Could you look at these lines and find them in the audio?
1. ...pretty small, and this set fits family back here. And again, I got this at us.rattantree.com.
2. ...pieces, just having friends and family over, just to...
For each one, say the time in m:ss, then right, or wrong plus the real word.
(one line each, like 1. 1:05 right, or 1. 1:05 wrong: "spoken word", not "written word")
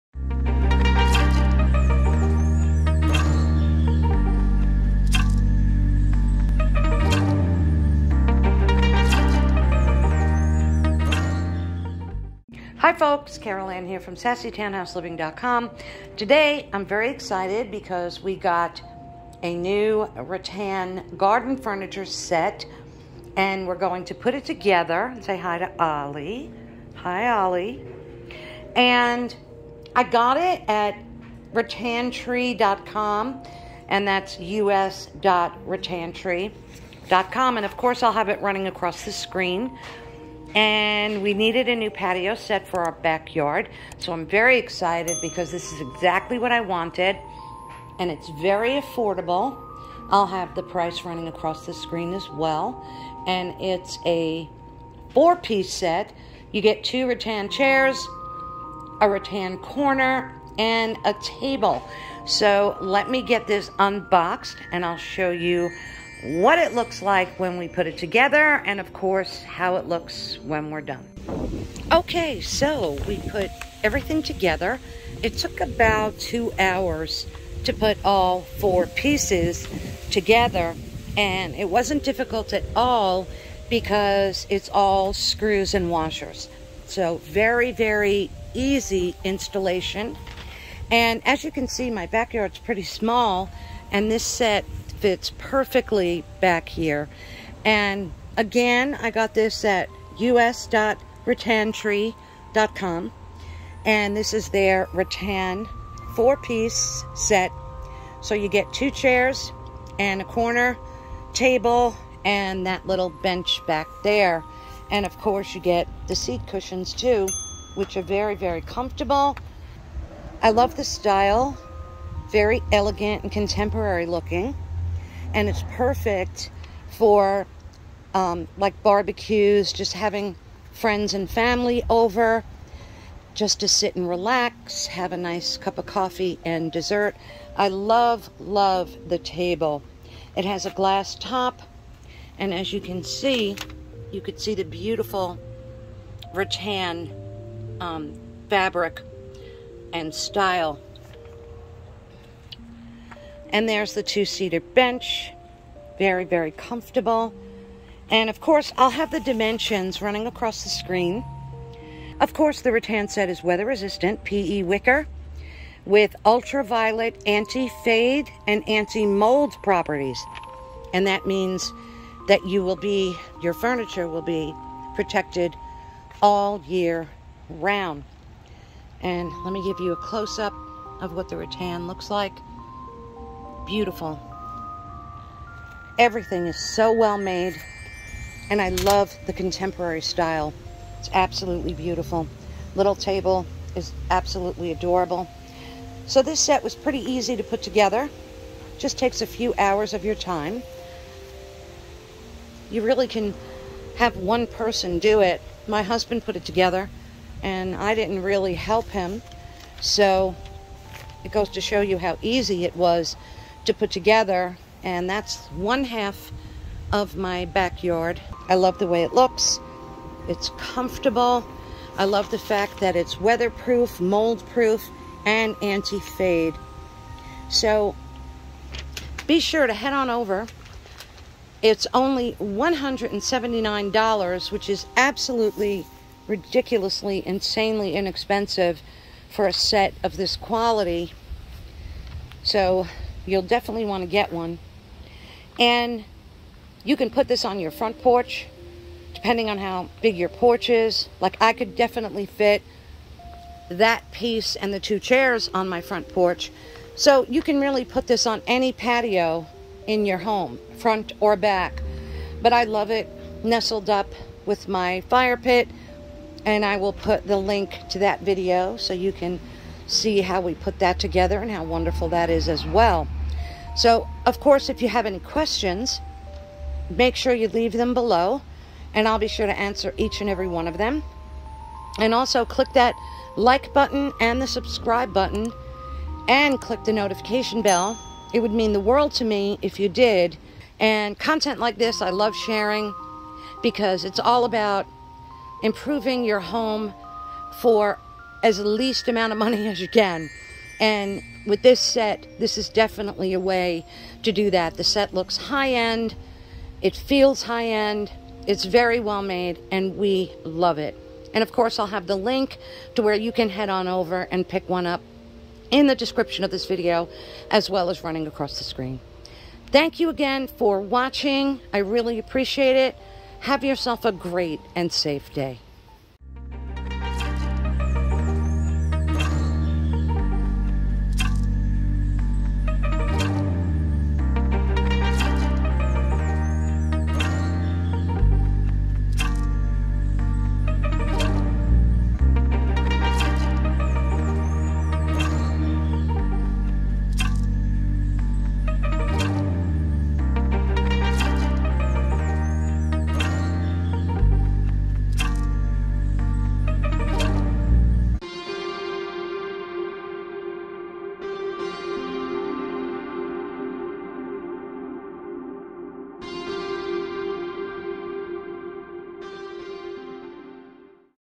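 1. 1:32 wrong: "perfectly", not "family"
2. 2:08 wrong: "barbecues", not "pieces".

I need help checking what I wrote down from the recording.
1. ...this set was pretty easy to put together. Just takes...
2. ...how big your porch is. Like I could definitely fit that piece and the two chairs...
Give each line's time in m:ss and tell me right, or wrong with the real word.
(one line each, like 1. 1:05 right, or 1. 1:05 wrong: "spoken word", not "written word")
1. 3:16 right
2. 4:09 right.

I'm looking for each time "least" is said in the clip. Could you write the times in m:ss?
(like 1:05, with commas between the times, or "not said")
4:58.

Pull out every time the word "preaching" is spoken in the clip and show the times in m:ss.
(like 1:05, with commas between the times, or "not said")
not said.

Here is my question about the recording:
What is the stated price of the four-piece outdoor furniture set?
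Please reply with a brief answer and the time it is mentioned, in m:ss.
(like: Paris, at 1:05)
$179, at 3:52.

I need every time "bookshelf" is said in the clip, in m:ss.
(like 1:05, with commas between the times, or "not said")
not said.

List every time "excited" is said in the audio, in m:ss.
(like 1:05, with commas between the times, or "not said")
0:17, 0:44.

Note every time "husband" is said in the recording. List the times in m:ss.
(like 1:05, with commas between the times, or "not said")
3:25.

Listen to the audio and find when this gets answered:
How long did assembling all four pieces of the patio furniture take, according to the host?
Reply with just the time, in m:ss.
1:15.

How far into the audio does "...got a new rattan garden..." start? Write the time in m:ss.
0:18.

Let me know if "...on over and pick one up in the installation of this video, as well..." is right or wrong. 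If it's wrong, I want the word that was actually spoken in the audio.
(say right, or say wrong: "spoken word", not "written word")
wrong: "description", not "installation".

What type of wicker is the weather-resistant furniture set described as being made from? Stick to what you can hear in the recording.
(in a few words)
PE wicker.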